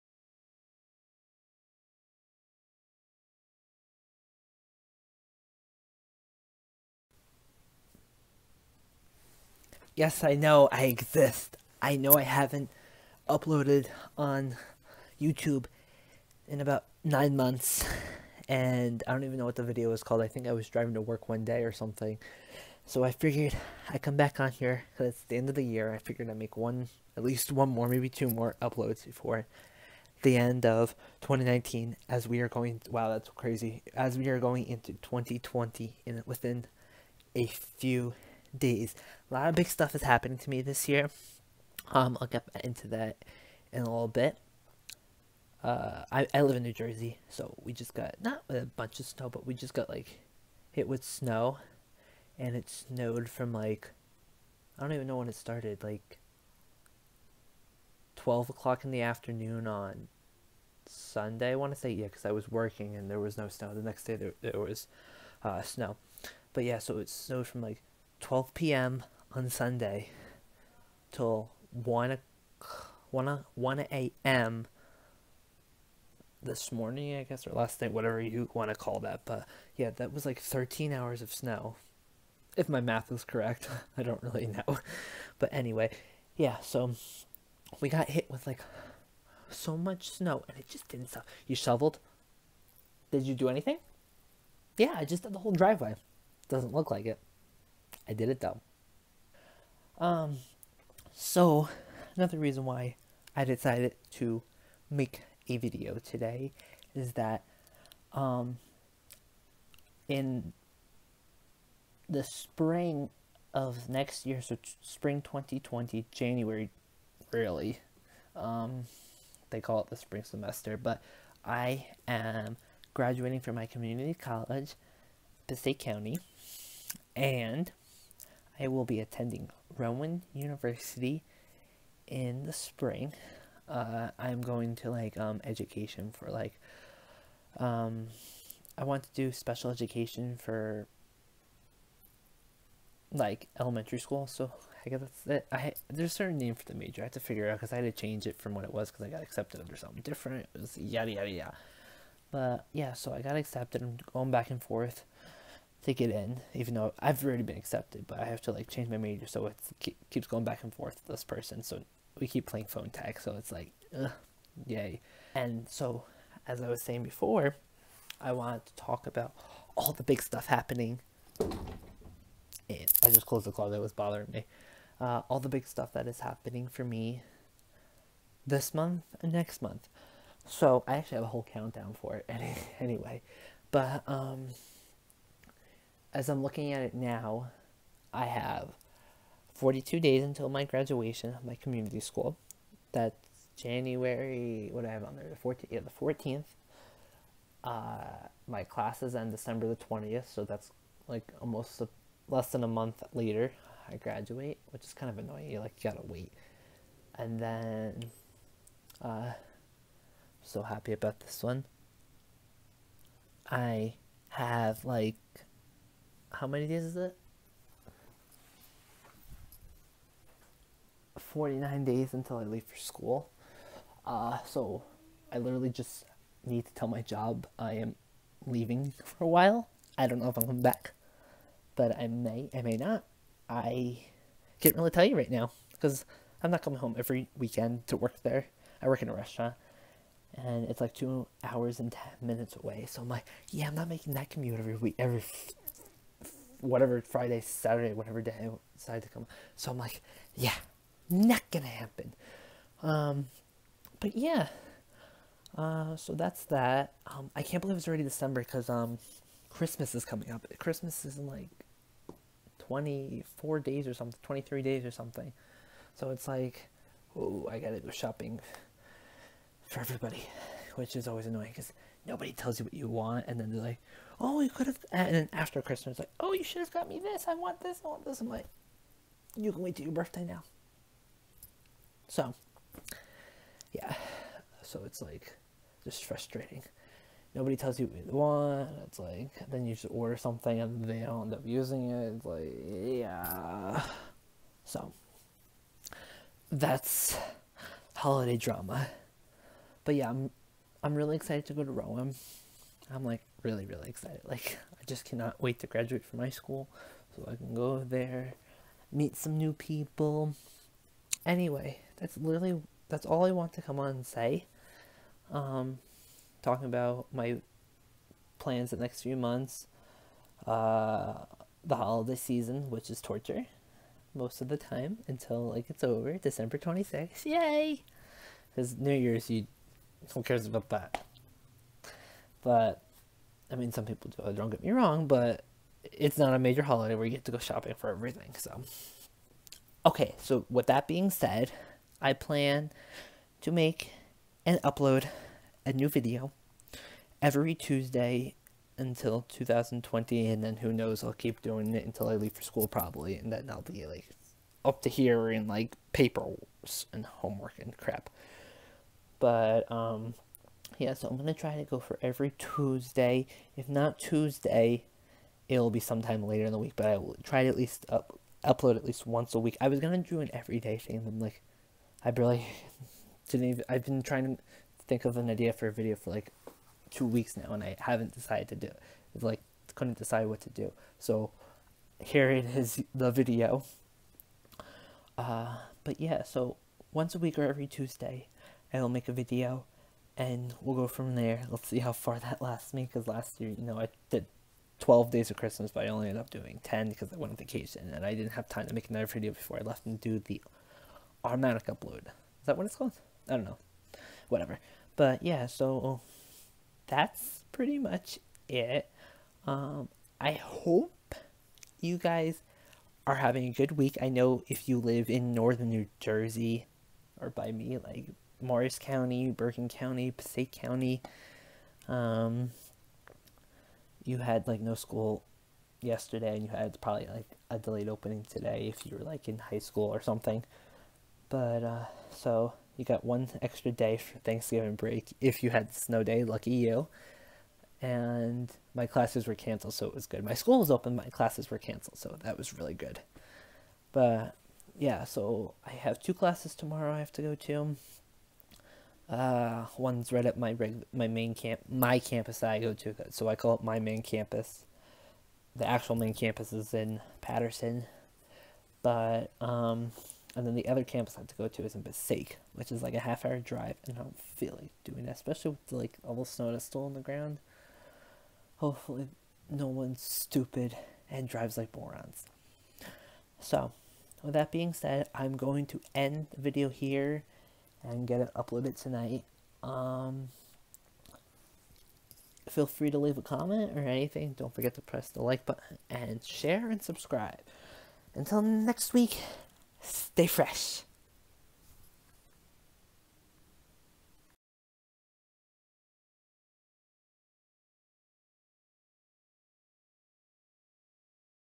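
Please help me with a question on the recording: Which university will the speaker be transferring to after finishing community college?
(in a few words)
Rowan University.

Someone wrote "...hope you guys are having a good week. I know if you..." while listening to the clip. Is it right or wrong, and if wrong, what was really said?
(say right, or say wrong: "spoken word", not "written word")
right.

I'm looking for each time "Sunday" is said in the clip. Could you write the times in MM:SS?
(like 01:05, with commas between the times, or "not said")
01:00, 01:09.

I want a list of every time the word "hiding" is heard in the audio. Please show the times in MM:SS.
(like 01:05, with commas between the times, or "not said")
not said.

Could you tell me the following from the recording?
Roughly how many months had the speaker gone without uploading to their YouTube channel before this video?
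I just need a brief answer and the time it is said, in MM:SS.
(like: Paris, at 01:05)
9, at 00:17.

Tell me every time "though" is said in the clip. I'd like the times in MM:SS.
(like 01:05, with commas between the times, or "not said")
01:38, 02:36.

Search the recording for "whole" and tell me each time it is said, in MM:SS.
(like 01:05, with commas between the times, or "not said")
01:35, 03:01.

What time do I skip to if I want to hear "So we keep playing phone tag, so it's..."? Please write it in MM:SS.
02:41.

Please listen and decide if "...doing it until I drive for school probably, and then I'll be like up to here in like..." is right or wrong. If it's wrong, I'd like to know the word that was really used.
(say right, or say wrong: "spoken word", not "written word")
wrong: "leave", not "drive".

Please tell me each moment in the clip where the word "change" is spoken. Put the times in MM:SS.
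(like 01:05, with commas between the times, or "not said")
02:27, 02:38.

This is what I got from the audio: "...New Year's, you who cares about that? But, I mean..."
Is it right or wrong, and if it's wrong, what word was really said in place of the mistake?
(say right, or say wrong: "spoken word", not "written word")
right.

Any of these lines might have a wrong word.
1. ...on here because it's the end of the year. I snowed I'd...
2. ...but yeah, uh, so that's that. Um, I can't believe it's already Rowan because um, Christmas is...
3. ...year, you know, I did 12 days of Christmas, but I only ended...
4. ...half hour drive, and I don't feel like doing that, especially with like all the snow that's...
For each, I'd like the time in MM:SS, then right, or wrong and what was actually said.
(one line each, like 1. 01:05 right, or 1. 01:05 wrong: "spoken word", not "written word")
1. 00:24 wrong: "figured", not "snowed"
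2. 04:13 wrong: "December", not "Rowan"
3. 06:33 right
4. 07:42 right.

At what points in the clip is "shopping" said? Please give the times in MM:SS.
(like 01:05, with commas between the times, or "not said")
04:27, 05:37.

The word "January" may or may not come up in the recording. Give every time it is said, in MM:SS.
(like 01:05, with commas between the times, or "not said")
01:56, 03:13.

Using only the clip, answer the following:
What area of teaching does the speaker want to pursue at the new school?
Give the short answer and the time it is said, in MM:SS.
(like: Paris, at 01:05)
Special education, at 02:19.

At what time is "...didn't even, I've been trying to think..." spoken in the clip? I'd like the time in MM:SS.
06:13.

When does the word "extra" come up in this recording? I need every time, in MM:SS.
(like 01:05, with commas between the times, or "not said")
07:13.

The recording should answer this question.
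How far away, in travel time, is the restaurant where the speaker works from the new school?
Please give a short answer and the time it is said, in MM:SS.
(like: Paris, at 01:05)
2 hours 10 minutes, at 04:00.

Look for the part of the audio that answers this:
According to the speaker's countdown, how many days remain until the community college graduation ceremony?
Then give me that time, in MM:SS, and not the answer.
03:09.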